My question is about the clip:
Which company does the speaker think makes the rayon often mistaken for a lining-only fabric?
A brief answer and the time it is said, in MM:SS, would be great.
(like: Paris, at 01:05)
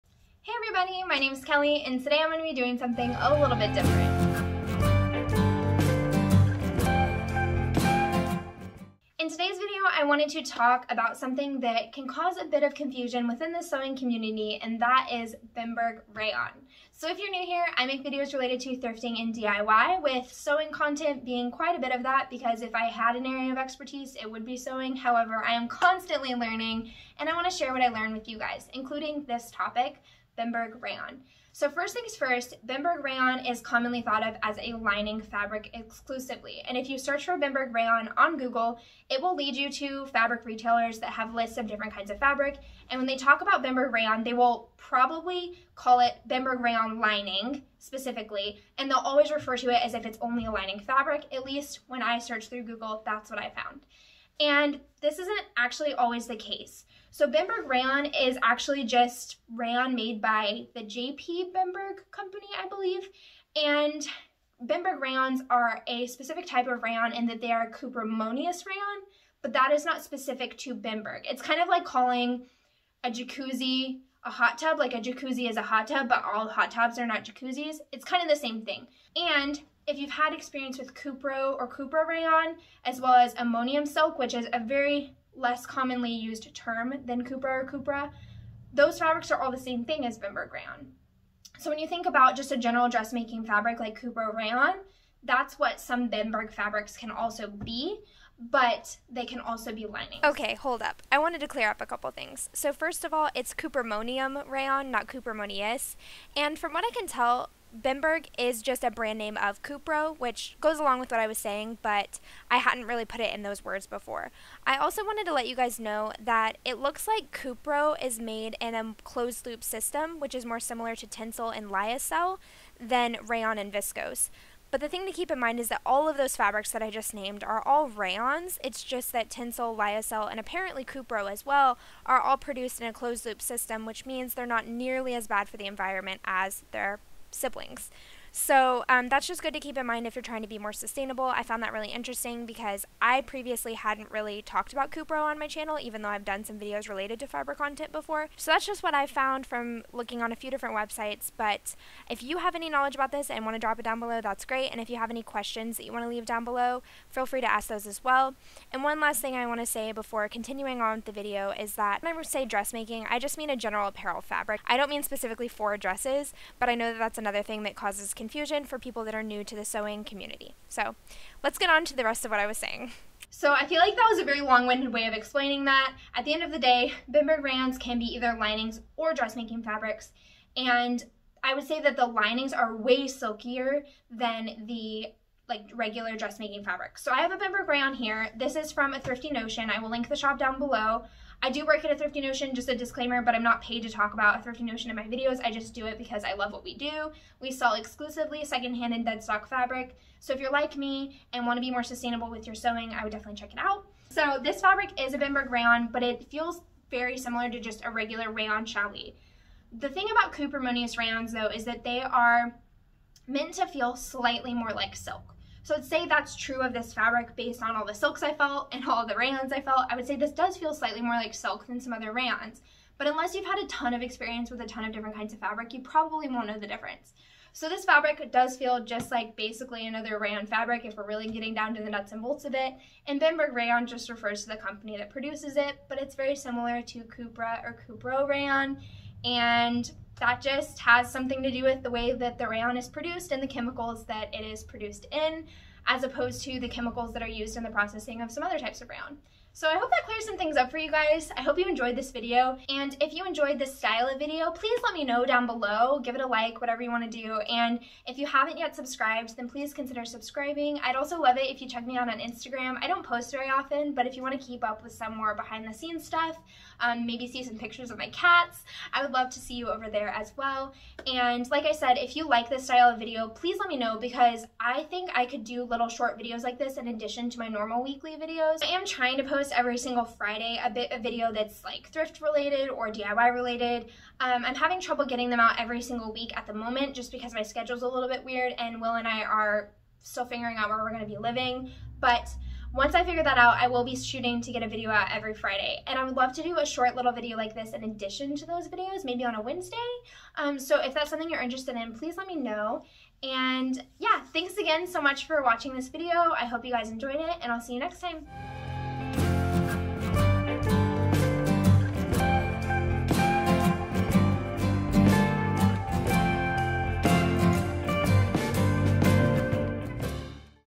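JP Bemberg, at 01:00.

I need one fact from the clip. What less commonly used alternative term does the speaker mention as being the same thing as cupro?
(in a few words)
ammonium silk.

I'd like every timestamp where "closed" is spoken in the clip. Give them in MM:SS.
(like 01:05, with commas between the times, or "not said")
01:59, 02:12.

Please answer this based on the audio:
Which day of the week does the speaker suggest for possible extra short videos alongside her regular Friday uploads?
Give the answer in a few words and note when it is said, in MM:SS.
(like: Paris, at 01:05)
Wednesday, at 04:59.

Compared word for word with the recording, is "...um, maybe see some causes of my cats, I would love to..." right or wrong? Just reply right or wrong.
wrong.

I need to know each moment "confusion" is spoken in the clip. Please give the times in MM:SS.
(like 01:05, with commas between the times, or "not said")
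00:12, 02:48.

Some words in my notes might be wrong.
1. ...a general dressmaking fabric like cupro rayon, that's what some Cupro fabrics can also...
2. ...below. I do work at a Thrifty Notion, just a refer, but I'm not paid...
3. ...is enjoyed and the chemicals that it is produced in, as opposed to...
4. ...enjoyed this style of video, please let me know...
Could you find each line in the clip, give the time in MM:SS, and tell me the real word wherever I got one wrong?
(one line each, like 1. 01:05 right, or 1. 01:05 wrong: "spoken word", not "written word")
1. 01:32 wrong: "Bemberg", not "Cupro"
2. 03:10 wrong: "disclaimer", not "refer"
3. 04:02 wrong: "produced", not "enjoyed"
4. 04:13 right.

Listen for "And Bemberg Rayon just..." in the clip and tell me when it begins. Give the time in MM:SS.
03:53.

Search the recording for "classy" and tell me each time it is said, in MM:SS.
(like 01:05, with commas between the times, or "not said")
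not said.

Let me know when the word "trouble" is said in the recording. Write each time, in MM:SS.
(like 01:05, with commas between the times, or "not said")
04:44.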